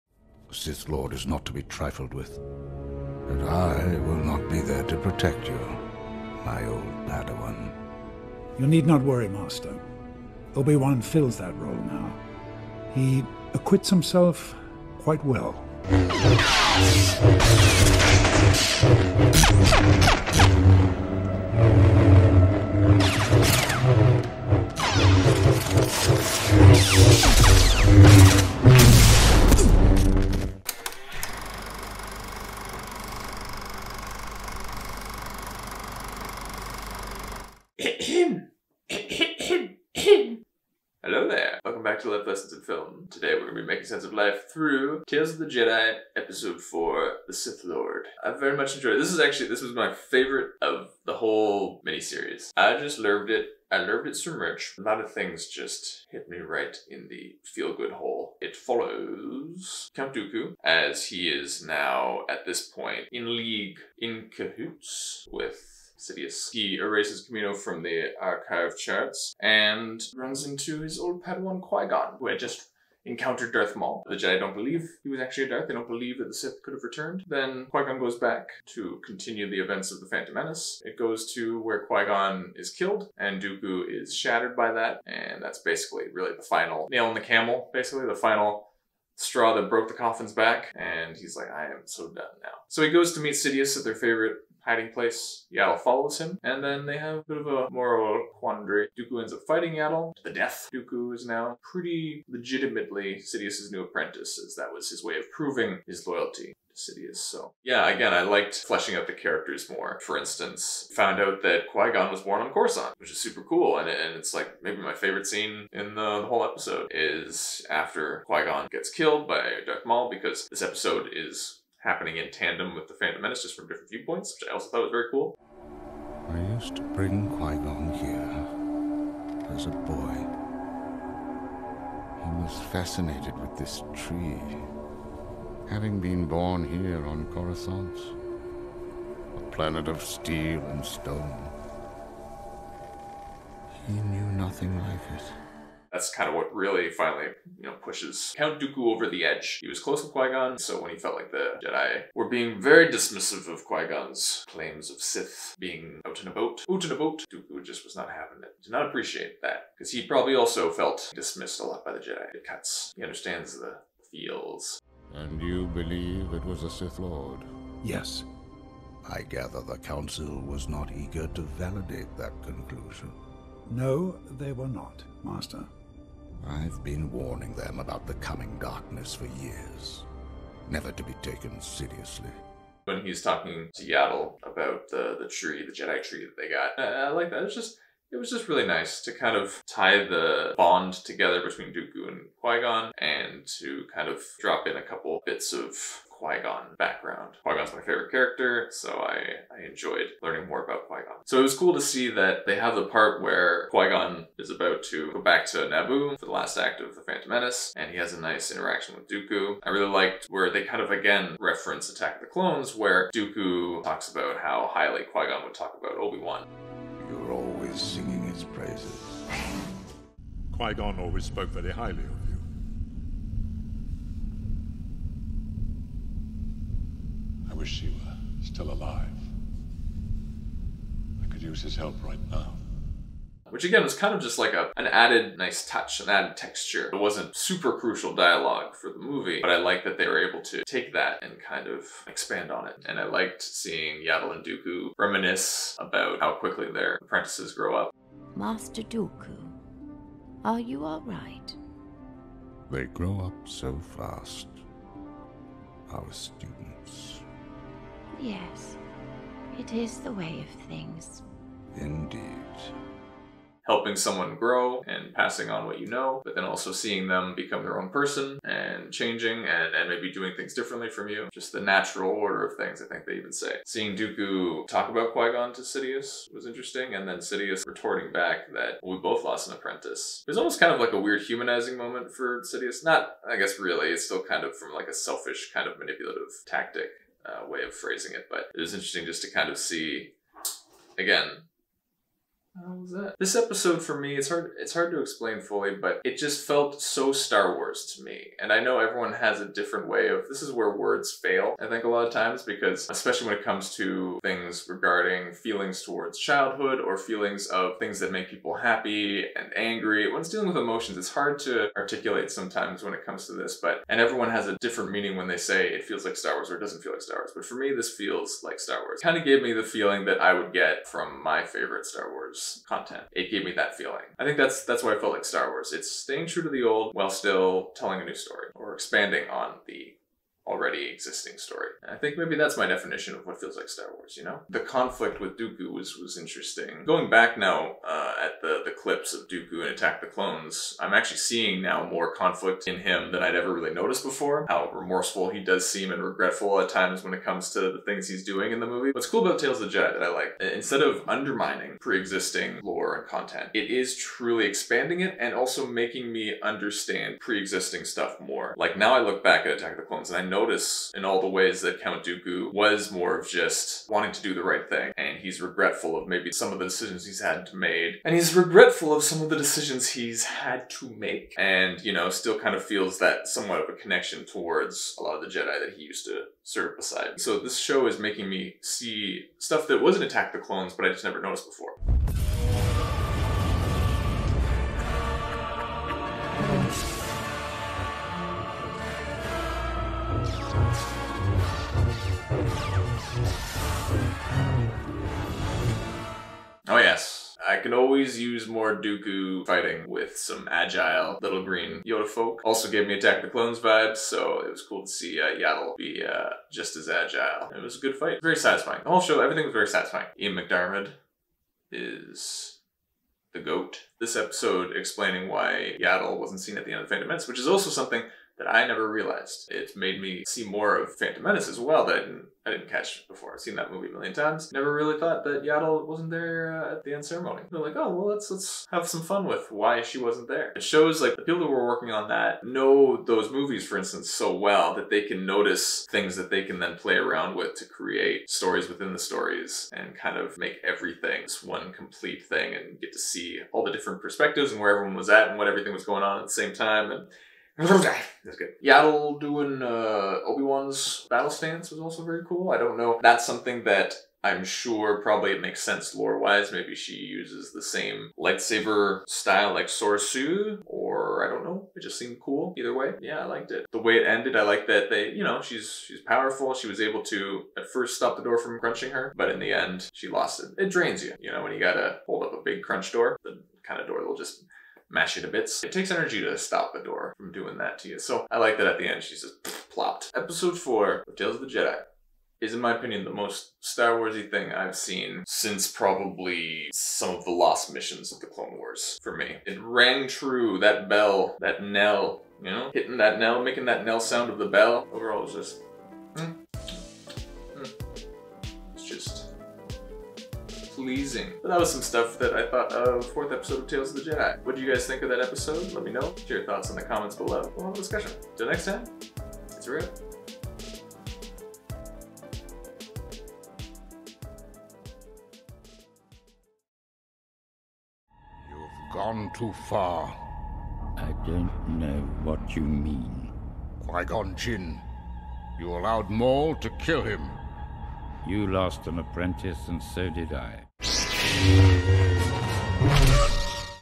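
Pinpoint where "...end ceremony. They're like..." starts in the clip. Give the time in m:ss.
7:06.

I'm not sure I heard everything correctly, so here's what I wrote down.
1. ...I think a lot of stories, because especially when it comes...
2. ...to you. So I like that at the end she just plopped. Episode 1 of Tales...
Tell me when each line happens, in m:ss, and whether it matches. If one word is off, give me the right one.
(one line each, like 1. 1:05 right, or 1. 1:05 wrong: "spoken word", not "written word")
1. 5:01 wrong: "times", not "stories"
2. 7:57 wrong: "4", not "1".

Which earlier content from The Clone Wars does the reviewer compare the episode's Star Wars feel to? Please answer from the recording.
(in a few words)
The Lost Missions.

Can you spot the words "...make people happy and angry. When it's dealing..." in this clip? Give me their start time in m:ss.
5:08.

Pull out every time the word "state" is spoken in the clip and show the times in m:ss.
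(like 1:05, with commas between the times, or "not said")
not said.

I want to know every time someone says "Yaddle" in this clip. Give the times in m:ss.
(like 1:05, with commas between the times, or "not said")
1:35, 1:39, 3:03, 4:04, 6:45, 6:55, 7:05, 7:28.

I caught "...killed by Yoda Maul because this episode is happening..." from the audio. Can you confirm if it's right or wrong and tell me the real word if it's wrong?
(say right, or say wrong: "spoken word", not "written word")
wrong: "Darth", not "Yoda".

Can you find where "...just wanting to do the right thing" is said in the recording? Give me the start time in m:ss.
6:03.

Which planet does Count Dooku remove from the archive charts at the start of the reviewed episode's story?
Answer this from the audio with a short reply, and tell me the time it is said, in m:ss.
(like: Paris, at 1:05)
Camino, at 1:07.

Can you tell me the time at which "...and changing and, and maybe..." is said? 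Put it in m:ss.
4:28.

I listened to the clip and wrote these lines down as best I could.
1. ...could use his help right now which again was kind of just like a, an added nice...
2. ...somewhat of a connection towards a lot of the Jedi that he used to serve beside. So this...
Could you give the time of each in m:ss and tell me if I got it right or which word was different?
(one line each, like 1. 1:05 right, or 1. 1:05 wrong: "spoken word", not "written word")
1. 3:51 right
2. 6:13 right.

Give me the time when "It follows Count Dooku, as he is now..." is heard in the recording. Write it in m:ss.
0:58.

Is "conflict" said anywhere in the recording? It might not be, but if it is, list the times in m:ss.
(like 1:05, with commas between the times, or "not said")
5:34, 5:42.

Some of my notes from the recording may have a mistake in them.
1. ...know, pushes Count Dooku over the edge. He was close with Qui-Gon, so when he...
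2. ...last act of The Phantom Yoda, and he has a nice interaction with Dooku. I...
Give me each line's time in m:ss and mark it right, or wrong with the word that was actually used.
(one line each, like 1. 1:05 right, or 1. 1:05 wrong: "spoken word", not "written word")
1. 2:27 right
2. 3:26 wrong: "Menace", not "Yoda".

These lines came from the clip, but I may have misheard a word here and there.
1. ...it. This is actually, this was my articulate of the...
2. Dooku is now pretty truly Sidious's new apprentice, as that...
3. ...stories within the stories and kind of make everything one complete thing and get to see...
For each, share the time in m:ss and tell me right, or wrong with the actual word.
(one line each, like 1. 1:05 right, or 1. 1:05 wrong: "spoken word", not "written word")
1. 0:48 wrong: "favorite", not "articulate"
2. 1:40 wrong: "legitimately", not "truly"
3. 7:18 right.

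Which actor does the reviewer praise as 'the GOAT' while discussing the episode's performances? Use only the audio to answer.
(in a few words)
Ian McDiarmid.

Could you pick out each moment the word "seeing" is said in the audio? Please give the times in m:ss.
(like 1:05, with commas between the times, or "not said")
4:03, 4:26, 4:33, 5:41.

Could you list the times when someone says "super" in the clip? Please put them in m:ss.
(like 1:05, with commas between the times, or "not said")
1:53, 3:57.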